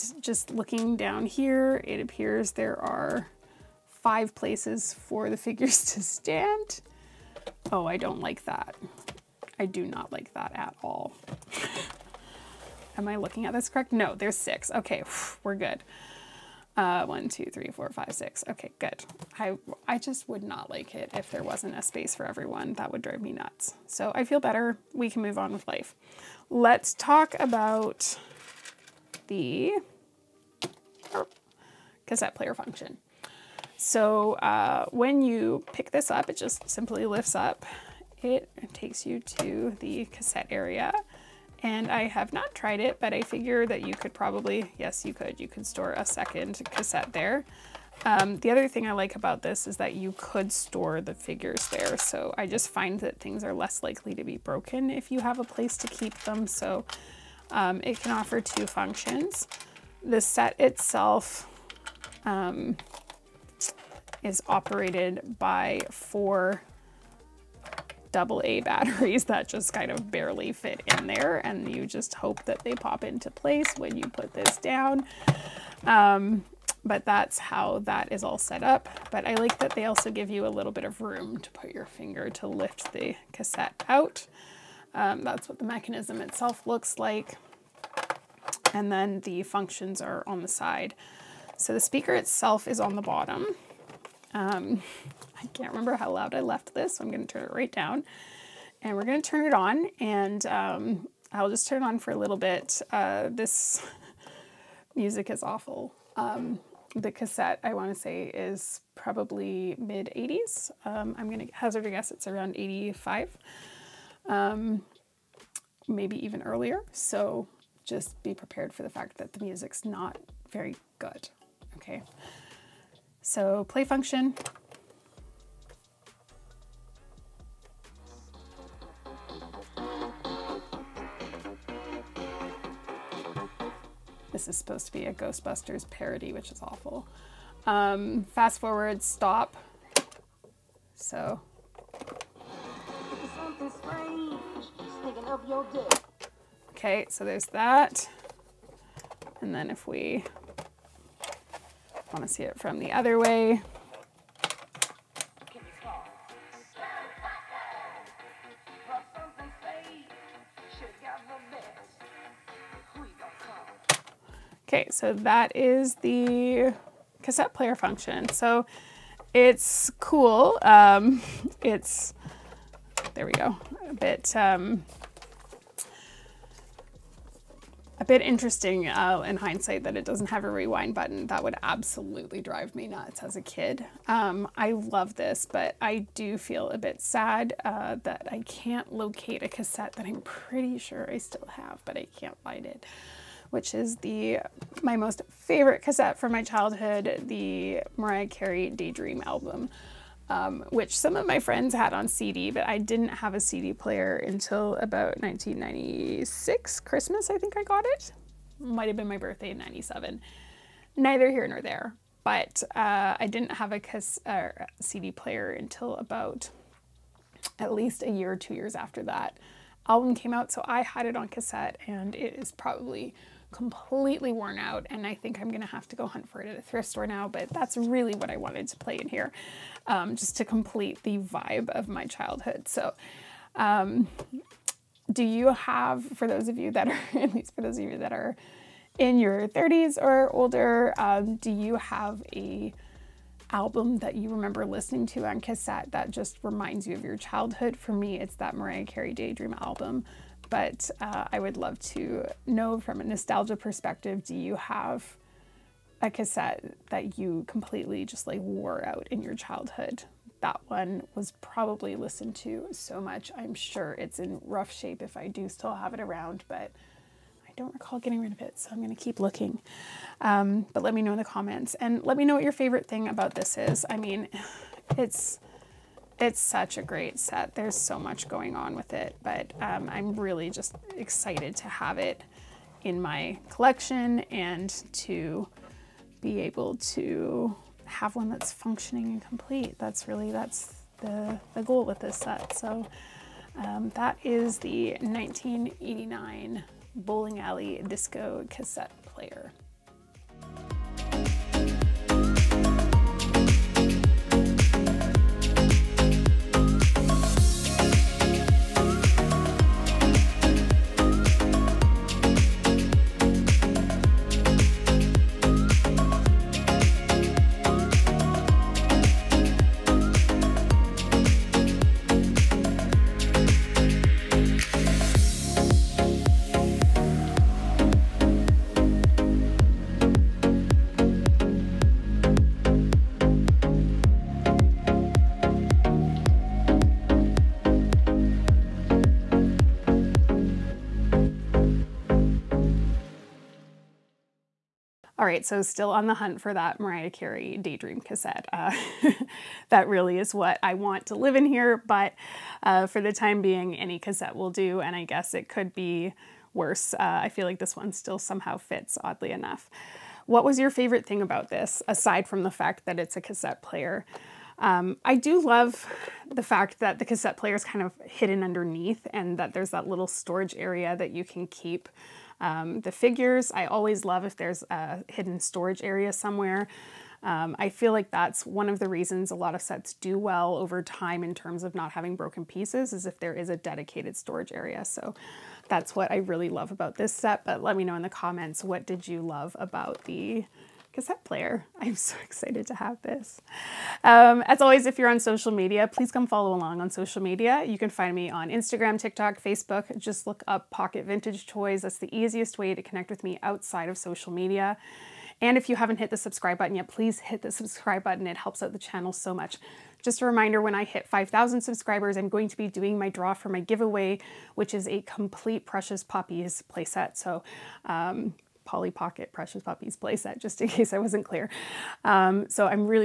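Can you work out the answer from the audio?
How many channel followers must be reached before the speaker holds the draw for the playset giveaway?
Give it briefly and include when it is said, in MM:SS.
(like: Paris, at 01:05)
5,000, at 06:51.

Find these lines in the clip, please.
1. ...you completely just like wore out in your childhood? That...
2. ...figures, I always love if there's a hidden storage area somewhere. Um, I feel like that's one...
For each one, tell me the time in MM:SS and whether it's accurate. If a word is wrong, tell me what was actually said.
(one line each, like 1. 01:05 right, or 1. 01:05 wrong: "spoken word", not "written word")
1. 04:17 right
2. 06:12 right.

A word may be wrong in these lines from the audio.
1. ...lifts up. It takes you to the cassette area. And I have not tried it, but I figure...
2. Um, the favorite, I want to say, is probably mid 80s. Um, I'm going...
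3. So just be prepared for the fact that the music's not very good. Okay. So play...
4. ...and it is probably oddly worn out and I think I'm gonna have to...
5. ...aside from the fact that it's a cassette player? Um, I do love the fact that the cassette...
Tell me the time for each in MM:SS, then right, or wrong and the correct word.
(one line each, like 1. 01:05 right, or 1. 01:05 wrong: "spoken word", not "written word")
1. 00:37 right
2. 01:46 wrong: "cassette", not "favorite"
3. 01:56 right
4. 03:41 wrong: "completely", not "oddly"
5. 06:01 right.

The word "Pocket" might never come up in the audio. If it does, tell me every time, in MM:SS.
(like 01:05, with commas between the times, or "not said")
06:40, 06:58.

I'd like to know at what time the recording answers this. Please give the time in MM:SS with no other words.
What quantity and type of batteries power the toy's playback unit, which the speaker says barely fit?
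01:05.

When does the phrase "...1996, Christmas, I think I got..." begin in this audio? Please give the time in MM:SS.
03:25.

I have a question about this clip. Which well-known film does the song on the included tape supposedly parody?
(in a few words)
Ghostbusters.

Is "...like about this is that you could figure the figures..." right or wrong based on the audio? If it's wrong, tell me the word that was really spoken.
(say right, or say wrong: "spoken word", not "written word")
wrong: "store", not "figure".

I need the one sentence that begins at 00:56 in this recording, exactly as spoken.
So um, it can offer two functions.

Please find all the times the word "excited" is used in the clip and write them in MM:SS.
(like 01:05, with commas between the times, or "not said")
04:40, 06:32.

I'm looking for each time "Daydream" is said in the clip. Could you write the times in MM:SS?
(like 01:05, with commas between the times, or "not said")
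03:18, 04:09, 05:47.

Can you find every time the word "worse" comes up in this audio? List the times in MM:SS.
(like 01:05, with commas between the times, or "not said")
05:56.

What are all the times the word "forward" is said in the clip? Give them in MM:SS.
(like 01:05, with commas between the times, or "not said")
02:18.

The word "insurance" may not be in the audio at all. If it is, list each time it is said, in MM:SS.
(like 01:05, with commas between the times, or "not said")
not said.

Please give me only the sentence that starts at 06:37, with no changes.
You can find me on Instagram, TikTok, Facebook.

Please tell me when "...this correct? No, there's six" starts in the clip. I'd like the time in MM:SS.
00:13.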